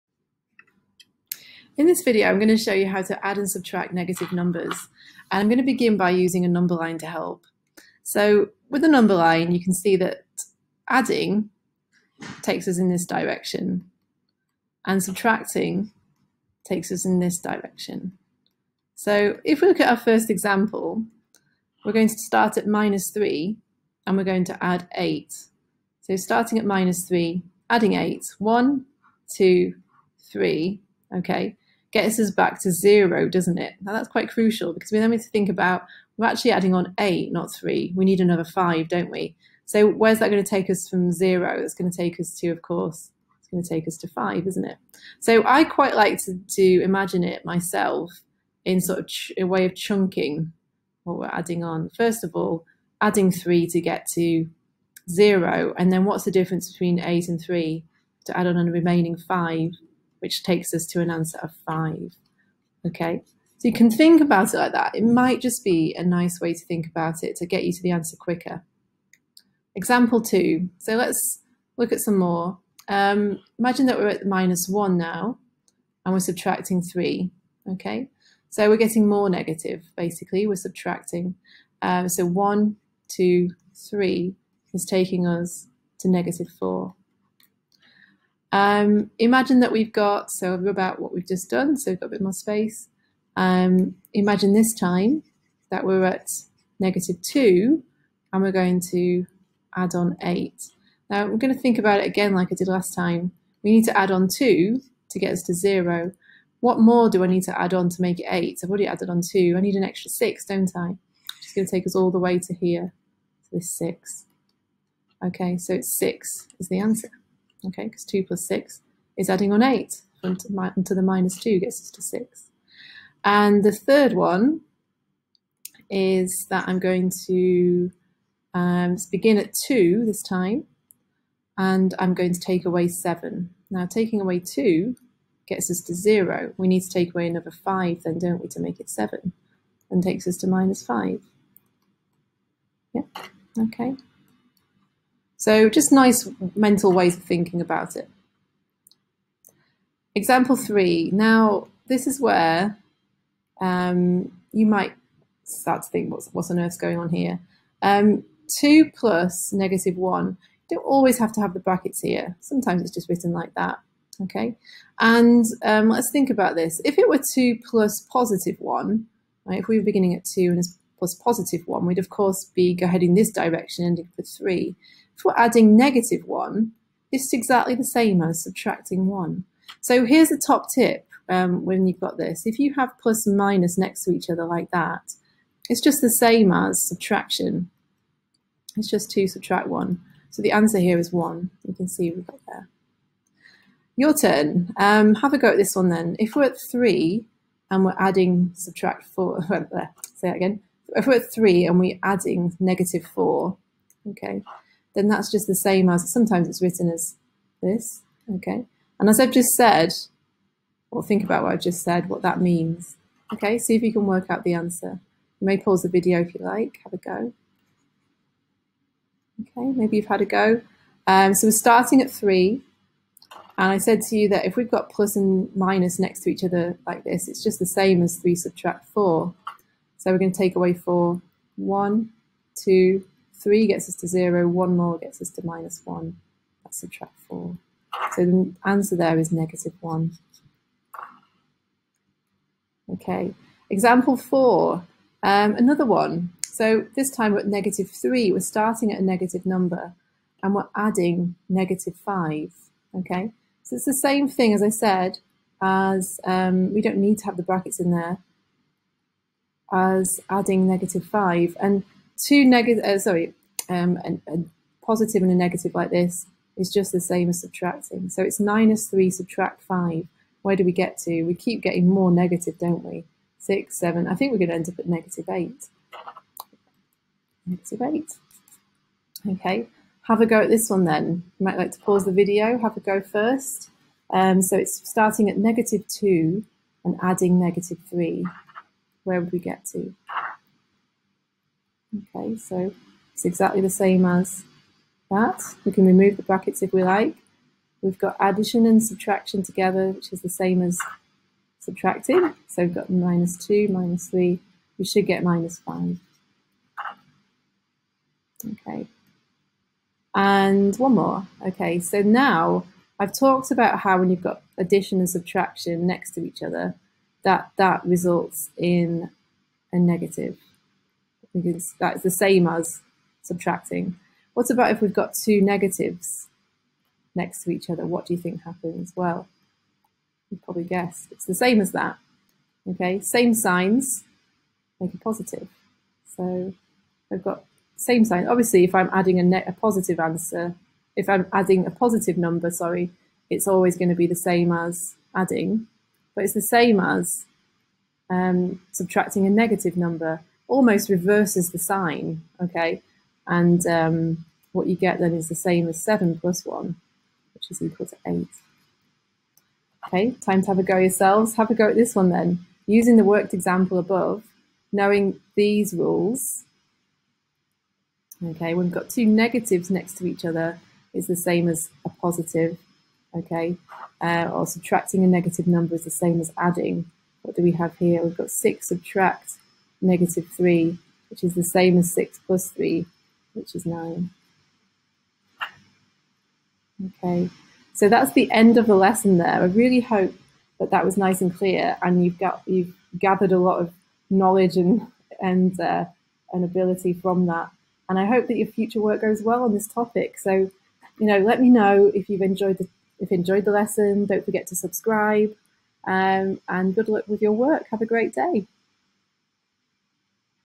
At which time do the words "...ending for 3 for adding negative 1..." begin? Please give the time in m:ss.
2:53.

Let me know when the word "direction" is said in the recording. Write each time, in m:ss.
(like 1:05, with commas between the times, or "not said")
0:13, 0:17, 2:53.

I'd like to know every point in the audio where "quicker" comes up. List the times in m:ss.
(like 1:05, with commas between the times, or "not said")
1:08.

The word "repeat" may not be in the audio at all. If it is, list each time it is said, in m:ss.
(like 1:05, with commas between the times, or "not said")
not said.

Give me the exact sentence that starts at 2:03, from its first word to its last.
And the third one is that I'm going to um, begin at 2 this time, and I'm going to take away 7.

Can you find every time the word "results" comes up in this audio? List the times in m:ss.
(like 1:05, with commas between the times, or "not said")
5:17.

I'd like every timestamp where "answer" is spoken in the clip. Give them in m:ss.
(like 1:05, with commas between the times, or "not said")
1:01, 1:07, 1:56, 3:10, 3:34, 3:58, 5:39.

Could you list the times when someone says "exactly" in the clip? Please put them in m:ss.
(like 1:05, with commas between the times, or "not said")
2:57, 4:53.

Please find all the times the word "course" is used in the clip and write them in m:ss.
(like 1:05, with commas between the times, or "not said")
0:42, 2:52.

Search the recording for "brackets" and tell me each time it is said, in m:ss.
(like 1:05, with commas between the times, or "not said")
2:41, 4:17, 4:56.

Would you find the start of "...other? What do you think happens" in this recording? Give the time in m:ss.
5:27.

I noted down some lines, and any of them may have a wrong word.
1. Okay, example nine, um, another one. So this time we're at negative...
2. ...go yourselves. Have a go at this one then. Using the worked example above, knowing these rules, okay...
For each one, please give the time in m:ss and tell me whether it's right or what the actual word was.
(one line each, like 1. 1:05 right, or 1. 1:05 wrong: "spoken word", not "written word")
1. 4:02 wrong: "four", not "nine"
2. 6:00 right.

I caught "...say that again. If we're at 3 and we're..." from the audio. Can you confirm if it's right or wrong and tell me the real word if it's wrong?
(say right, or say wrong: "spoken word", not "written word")
right.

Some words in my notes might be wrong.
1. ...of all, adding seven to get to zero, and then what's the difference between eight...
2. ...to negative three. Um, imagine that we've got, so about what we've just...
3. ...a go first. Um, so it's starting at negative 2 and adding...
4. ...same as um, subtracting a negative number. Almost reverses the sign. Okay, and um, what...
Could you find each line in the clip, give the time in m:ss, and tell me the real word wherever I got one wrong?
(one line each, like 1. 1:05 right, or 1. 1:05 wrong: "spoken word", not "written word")
1. 0:52 wrong: "three", not "seven"
2. 1:25 wrong: "four", not "three"
3. 4:42 right
4. 5:46 right.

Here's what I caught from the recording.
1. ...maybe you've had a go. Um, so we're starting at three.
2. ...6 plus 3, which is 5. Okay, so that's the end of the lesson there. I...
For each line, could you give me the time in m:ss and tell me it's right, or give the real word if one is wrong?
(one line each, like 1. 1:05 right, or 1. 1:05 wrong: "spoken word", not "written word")
1. 3:39 right
2. 6:21 wrong: "9", not "5".